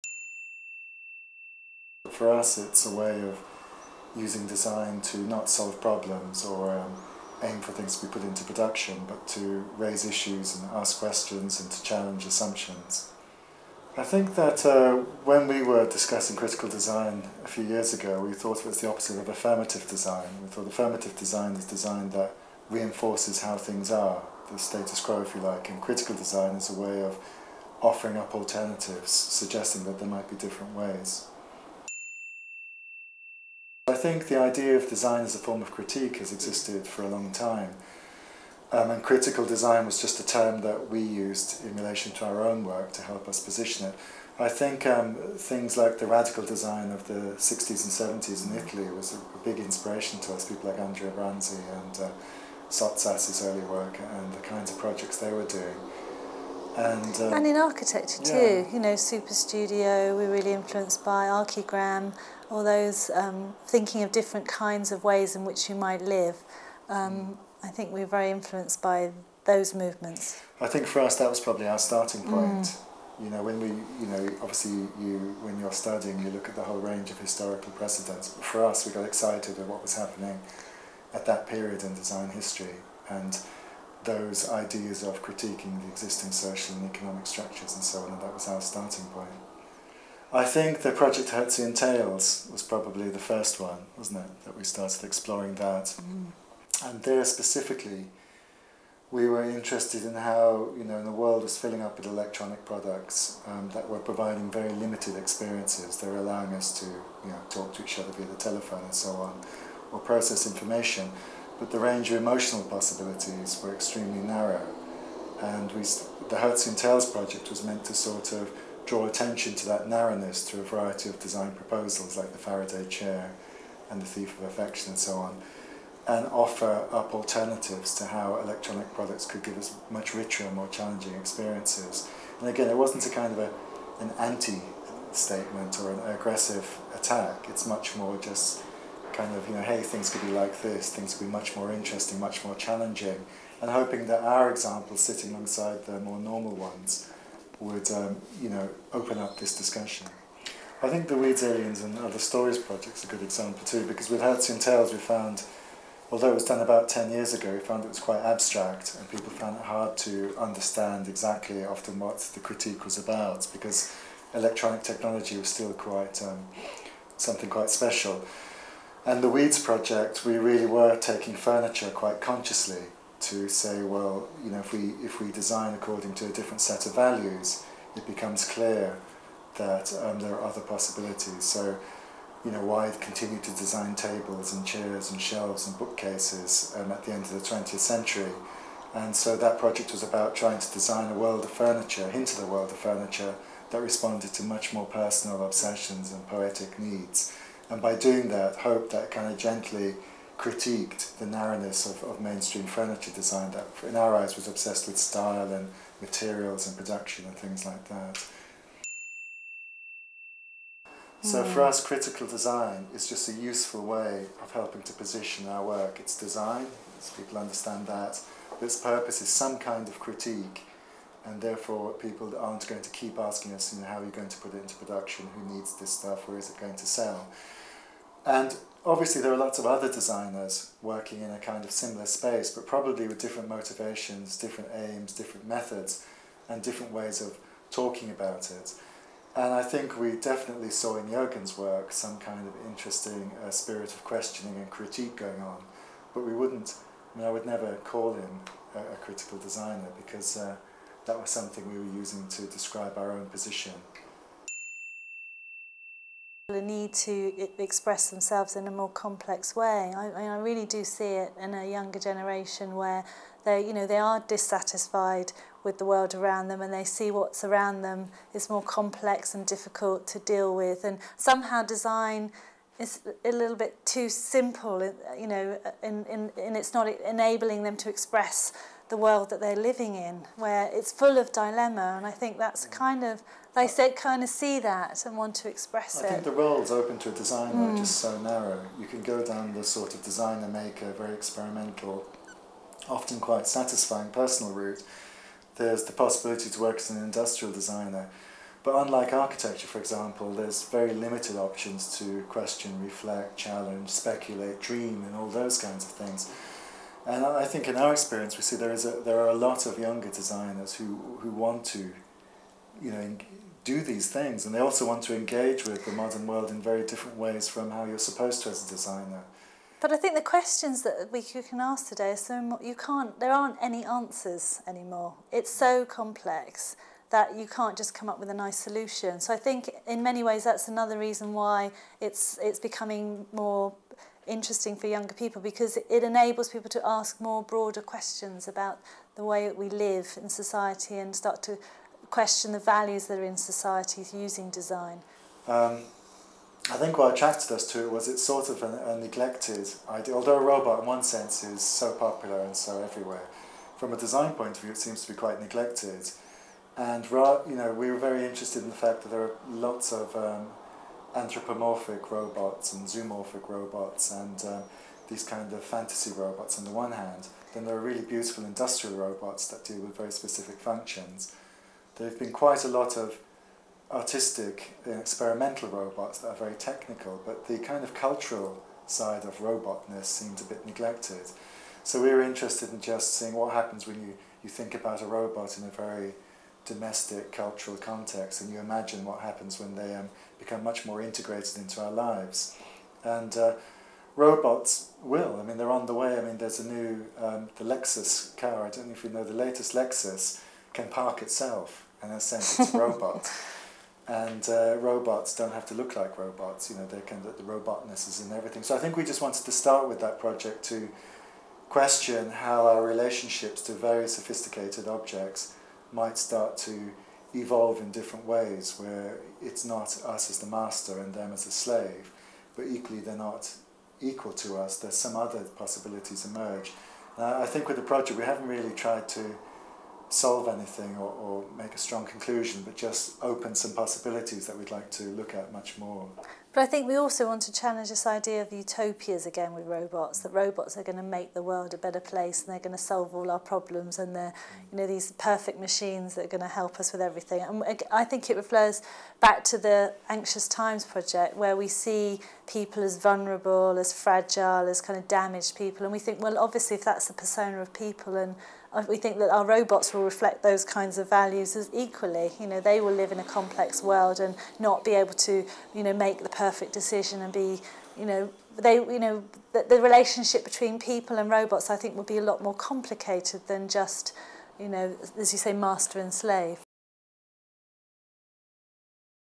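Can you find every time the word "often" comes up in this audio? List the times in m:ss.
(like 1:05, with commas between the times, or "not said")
2:41, 4:52.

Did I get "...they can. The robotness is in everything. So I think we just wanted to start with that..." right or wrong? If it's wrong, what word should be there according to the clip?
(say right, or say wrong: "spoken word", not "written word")
right.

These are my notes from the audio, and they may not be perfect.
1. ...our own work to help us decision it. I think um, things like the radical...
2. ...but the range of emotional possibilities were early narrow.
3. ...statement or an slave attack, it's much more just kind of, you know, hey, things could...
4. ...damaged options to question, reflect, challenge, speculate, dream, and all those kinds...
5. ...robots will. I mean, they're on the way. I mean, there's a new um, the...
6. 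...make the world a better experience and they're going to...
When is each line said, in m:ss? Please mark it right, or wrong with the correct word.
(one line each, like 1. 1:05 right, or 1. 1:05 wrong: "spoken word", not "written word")
1. 0:42 wrong: "position", not "decision"
2. 1:51 wrong: "extremely", not "early"
3. 2:15 wrong: "aggressive", not "slave"
4. 5:00 wrong: "limited", not "damaged"
5. 6:34 right
6. 7:21 wrong: "place", not "experience".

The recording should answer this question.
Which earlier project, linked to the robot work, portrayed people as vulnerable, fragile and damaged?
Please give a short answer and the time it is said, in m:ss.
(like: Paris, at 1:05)
Anxious Times, at 7:30.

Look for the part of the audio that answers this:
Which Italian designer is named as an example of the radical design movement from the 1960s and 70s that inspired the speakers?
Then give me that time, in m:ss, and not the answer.
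0:50.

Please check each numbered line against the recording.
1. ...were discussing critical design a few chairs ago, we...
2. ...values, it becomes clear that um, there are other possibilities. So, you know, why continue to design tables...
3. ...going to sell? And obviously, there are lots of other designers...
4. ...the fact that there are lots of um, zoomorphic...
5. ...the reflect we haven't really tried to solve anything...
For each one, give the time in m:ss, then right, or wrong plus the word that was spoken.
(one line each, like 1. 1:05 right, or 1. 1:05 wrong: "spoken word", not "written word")
1. 0:15 wrong: "years", not "chairs"
2. 2:56 right
3. 3:46 right
4. 5:58 wrong: "anthropomorphic", not "zoomorphic"
5. 7:07 wrong: "project", not "reflect".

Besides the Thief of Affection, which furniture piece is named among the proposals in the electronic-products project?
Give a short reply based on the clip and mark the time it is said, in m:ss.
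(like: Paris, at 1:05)
Faraday chair, at 2:02.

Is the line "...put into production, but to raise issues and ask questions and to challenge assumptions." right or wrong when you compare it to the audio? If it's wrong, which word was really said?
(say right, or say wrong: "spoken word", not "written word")
right.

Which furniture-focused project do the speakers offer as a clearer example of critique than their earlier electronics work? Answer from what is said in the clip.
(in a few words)
Weeds, Aliens and Other Stories.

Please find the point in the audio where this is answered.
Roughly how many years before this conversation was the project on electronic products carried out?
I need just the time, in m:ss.
2:36.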